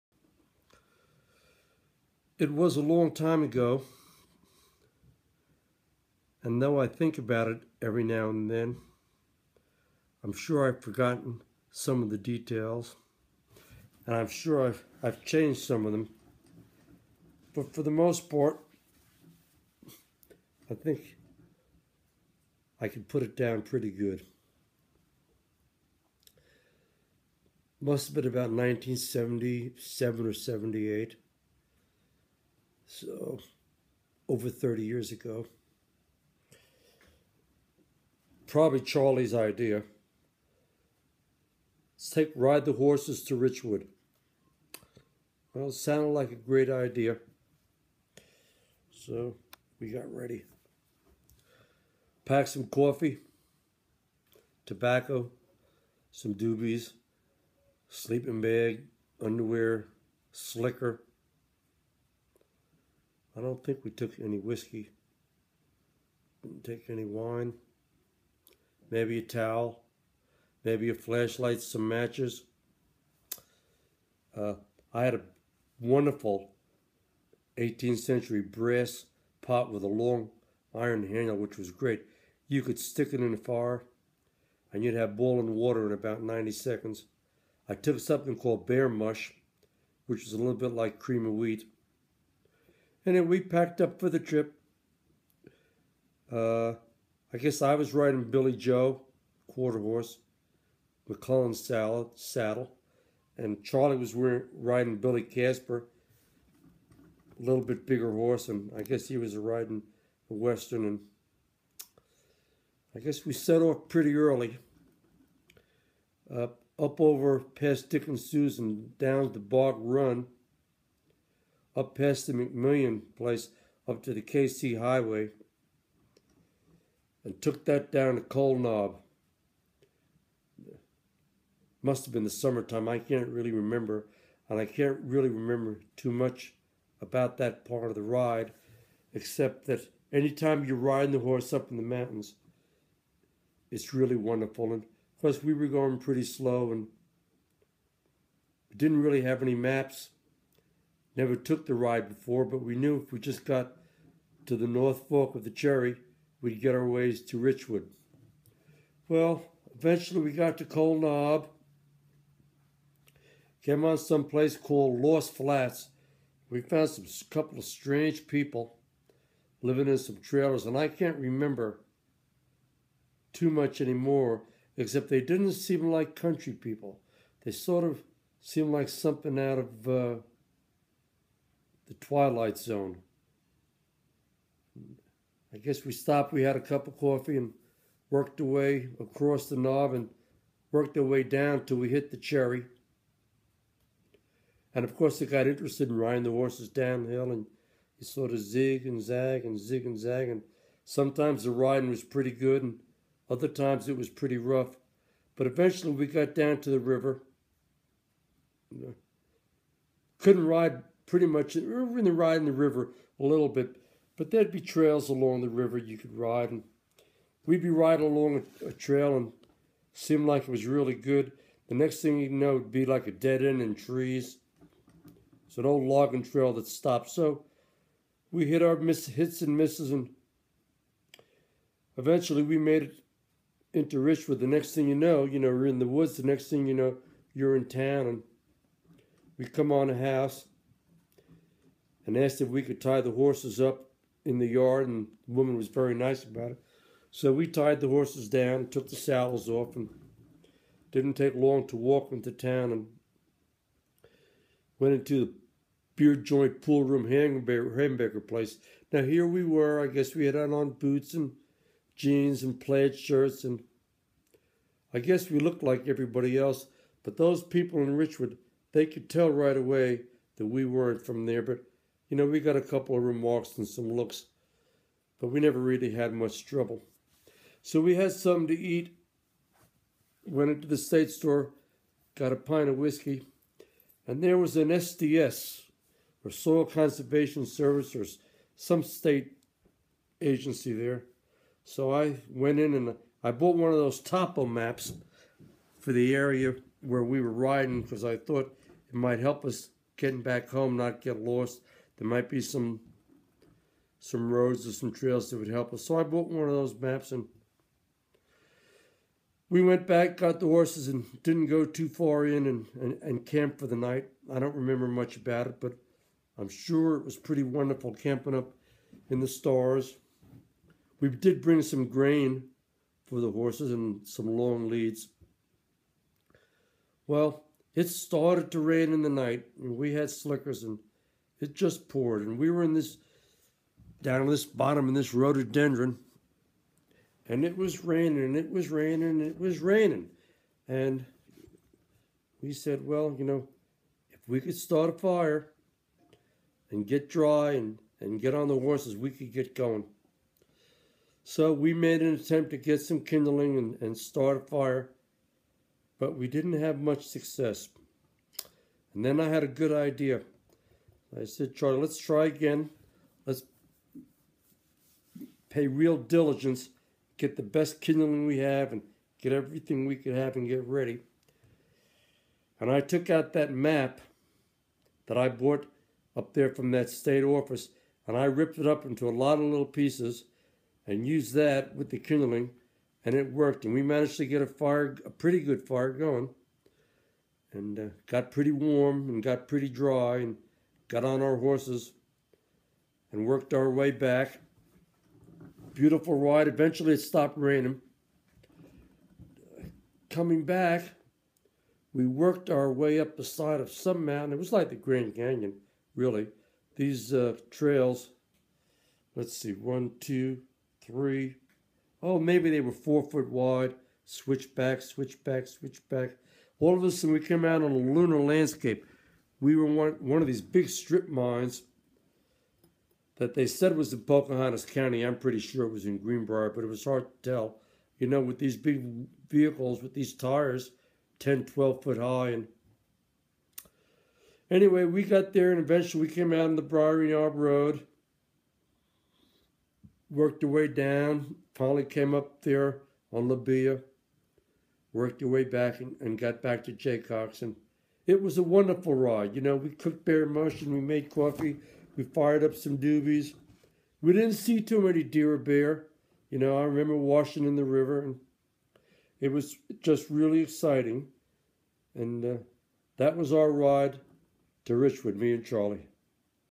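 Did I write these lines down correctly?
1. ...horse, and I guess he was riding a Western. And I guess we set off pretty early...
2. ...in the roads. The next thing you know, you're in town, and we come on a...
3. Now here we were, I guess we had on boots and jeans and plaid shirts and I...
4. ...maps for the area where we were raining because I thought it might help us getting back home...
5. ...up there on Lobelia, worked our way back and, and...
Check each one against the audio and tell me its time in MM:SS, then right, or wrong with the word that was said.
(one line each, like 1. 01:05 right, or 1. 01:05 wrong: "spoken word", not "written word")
1. 01:48 right
2. 03:55 wrong: "woods", not "roads"
3. 04:18 right
4. 04:54 wrong: "riding", not "raining"
5. 07:22 right.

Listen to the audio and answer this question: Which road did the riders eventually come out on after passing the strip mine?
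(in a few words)
Briar Yard Road.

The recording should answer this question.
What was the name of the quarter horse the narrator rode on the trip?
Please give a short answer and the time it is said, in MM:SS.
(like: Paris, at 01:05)
Billy Joe, at 01:38.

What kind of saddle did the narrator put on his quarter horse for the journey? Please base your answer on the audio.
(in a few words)
McClellan.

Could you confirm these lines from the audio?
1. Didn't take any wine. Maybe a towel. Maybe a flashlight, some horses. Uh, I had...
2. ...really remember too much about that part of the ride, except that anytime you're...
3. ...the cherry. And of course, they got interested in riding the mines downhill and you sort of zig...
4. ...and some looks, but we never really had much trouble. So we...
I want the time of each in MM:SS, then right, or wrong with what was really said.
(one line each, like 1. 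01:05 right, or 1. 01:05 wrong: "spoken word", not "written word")
1. 01:06 wrong: "matches", not "horses"
2. 02:15 right
3. 03:12 wrong: "horses", not "mines"
4. 04:33 right.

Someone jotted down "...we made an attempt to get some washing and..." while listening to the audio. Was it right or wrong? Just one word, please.
wrong.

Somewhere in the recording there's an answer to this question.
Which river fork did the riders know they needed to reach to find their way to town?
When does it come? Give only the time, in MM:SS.
02:34.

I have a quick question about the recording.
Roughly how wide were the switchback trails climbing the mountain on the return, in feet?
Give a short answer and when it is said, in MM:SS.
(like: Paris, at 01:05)
4, at 06:52.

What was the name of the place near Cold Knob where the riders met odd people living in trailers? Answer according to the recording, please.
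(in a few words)
Lost Flats.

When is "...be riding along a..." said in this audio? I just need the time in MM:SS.
03:37.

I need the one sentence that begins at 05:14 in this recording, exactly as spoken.
I don't remember much about it, but I'm sure it was pretty wonderful camping up in the stars.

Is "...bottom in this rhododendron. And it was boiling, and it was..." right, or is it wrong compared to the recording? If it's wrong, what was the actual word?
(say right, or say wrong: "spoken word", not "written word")
wrong: "raining", not "boiling".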